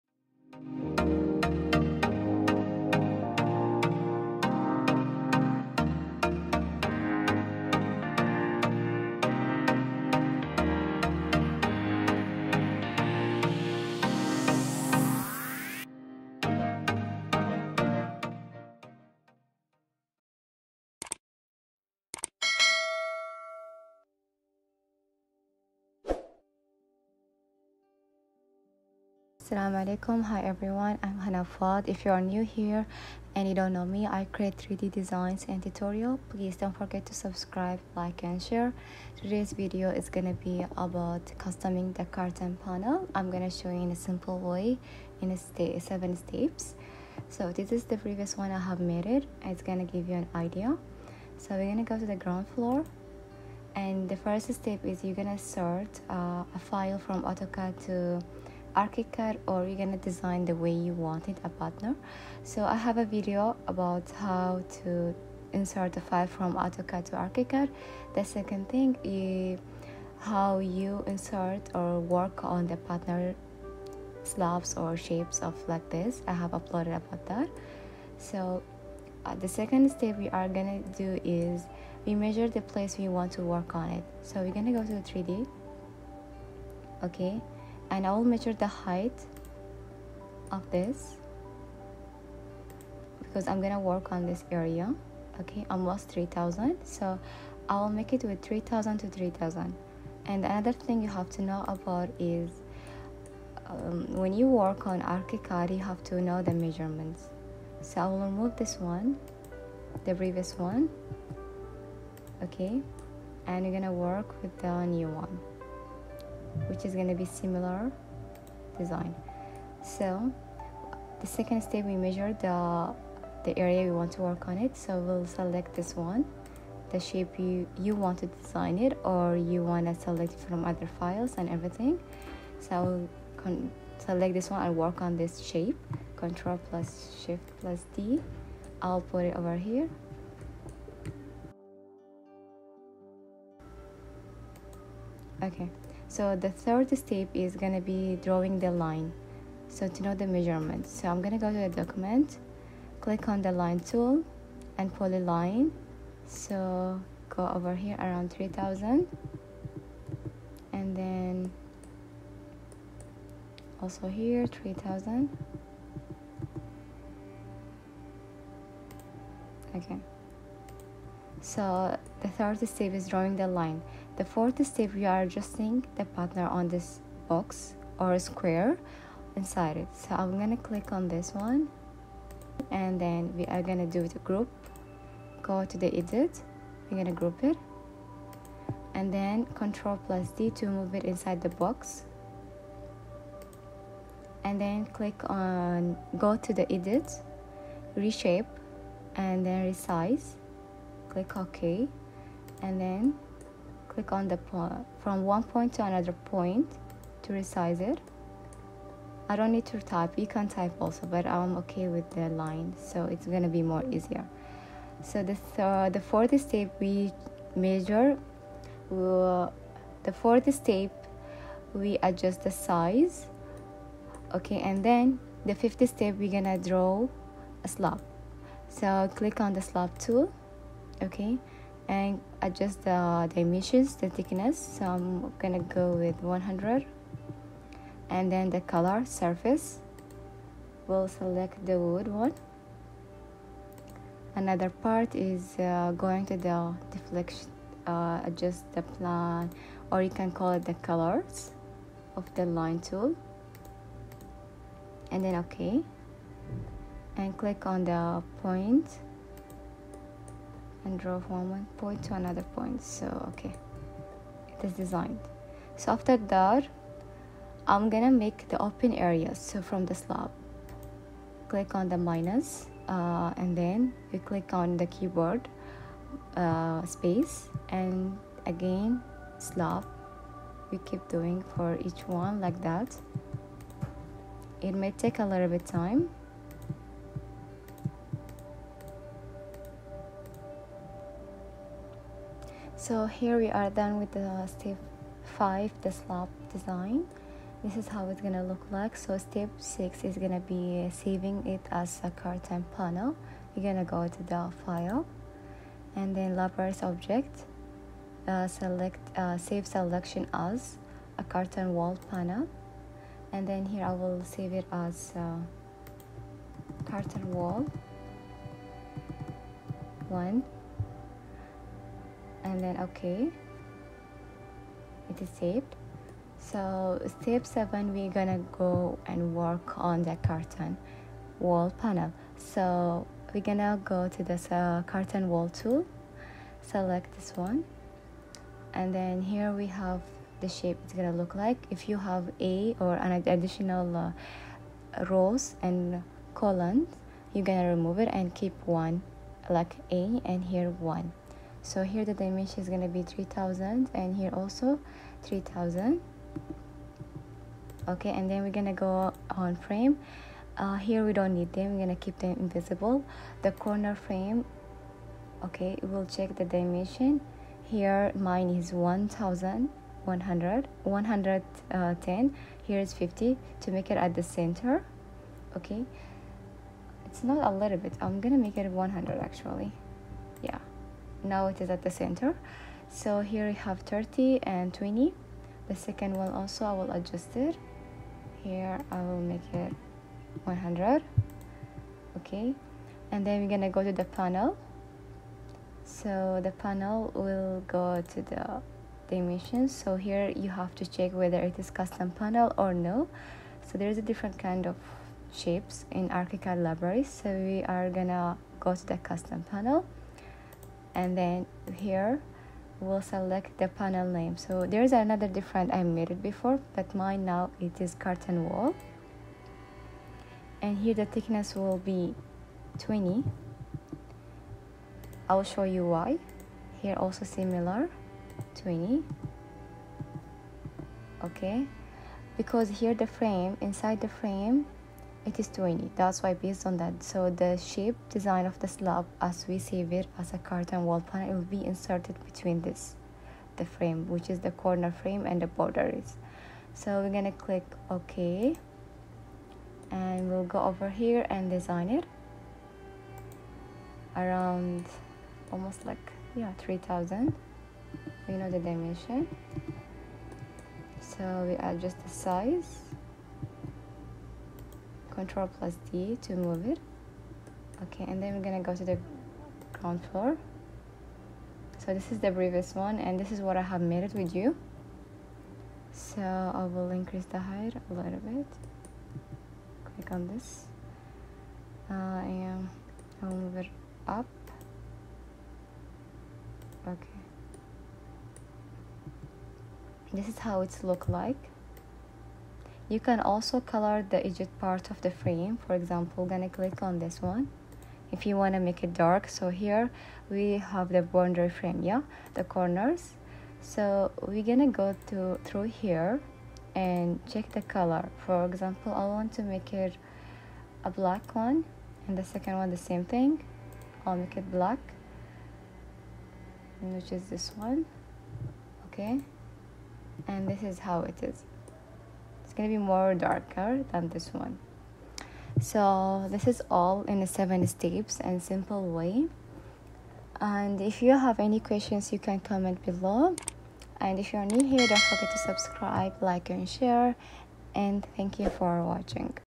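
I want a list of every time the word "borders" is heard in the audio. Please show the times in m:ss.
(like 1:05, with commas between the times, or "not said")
7:25.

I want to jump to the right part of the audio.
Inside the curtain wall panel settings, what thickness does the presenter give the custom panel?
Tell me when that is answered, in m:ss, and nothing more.
7:00.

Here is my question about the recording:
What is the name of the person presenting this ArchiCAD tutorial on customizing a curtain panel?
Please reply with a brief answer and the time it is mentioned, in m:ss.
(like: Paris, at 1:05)
Hana Fouad, at 0:31.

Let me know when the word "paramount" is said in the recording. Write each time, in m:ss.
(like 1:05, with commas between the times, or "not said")
not said.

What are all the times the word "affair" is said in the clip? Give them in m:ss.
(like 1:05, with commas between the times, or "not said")
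not said.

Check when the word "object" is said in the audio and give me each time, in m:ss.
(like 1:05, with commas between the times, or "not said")
5:06.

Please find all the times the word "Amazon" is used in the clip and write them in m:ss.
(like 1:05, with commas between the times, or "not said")
not said.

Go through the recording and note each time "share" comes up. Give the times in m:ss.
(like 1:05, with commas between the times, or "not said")
0:38, 8:56.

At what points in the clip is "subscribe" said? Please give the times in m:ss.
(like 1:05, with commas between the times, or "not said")
0:37, 8:55.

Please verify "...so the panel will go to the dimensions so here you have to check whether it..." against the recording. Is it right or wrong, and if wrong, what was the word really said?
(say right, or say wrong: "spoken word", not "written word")
right.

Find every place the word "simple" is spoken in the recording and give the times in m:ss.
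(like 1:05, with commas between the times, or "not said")
0:43, 8:48.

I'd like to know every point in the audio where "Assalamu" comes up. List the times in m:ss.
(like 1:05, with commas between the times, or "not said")
0:29.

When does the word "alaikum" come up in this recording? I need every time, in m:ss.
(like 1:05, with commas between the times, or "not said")
0:29.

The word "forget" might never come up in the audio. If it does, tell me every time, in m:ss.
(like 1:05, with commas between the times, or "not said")
0:36, 8:55.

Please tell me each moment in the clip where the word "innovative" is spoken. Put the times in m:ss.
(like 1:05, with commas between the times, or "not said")
not said.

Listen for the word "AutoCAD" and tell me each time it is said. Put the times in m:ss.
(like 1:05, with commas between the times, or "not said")
0:57, 1:06.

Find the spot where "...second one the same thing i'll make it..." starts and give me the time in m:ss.
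8:32.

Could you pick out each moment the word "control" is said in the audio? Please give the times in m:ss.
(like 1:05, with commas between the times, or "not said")
2:16, 3:09, 7:45.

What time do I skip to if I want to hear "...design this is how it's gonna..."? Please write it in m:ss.
4:56.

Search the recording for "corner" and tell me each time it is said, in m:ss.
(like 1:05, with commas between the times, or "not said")
6:03, 7:24, 8:22.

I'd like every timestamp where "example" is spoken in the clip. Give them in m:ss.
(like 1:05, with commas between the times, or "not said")
8:15, 8:28.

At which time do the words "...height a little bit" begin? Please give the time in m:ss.
7:57.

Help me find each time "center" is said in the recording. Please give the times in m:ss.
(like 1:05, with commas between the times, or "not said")
6:14, 6:21.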